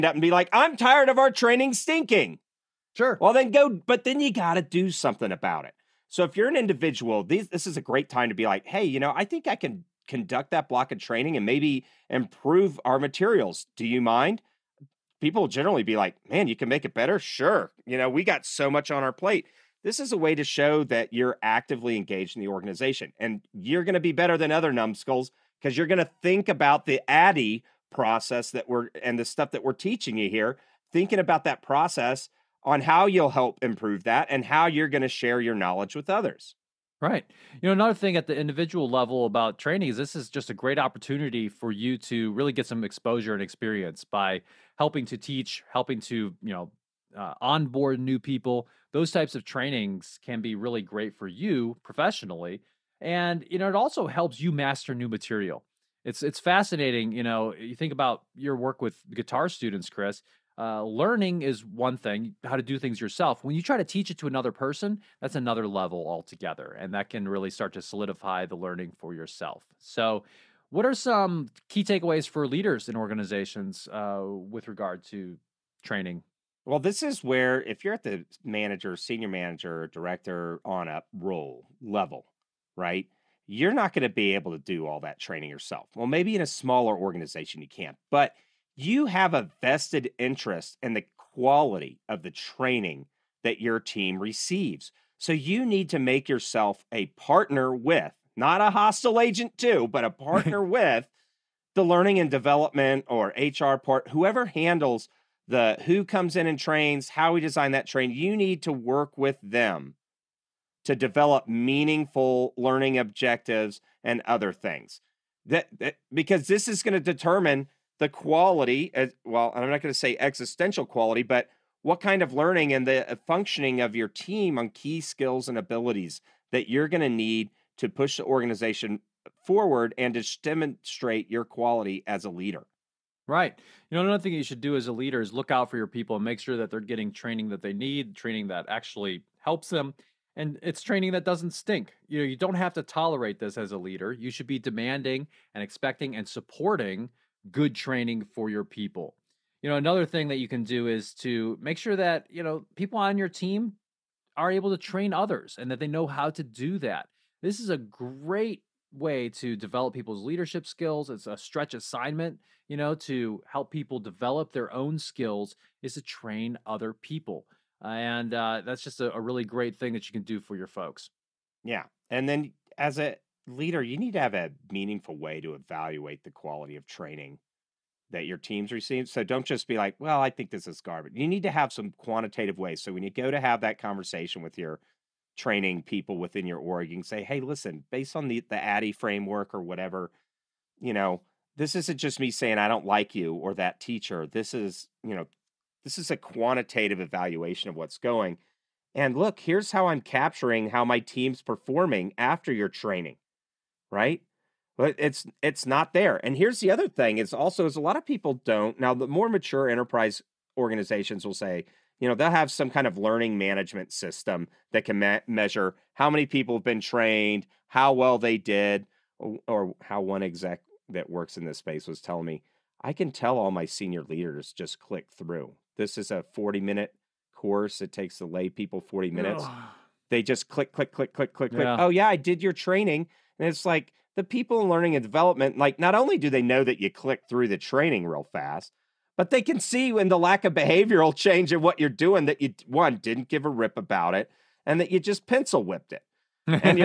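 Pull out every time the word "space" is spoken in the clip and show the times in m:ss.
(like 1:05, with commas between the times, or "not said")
3:41.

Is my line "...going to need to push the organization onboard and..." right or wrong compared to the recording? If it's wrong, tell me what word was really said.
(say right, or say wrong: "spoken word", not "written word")
wrong: "forward", not "onboard".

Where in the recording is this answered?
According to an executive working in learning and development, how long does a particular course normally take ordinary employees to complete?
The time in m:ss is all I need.
3:46.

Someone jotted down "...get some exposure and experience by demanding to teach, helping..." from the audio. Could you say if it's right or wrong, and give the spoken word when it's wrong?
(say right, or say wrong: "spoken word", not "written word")
wrong: "helping", not "demanding".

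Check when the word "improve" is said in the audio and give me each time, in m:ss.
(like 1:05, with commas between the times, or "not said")
0:12, 0:33.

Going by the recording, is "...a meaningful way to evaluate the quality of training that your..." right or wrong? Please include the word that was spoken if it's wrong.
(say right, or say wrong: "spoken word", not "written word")
right.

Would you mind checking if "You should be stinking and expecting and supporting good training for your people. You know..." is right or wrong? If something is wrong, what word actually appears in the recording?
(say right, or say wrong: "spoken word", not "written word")
wrong: "demanding", not "stinking".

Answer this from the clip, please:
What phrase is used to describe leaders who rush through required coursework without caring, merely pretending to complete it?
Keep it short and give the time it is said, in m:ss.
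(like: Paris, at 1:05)
pencil whipped, at 4:05.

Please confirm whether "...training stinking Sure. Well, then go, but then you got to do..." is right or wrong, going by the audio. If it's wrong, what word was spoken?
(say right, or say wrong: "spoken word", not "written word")
right.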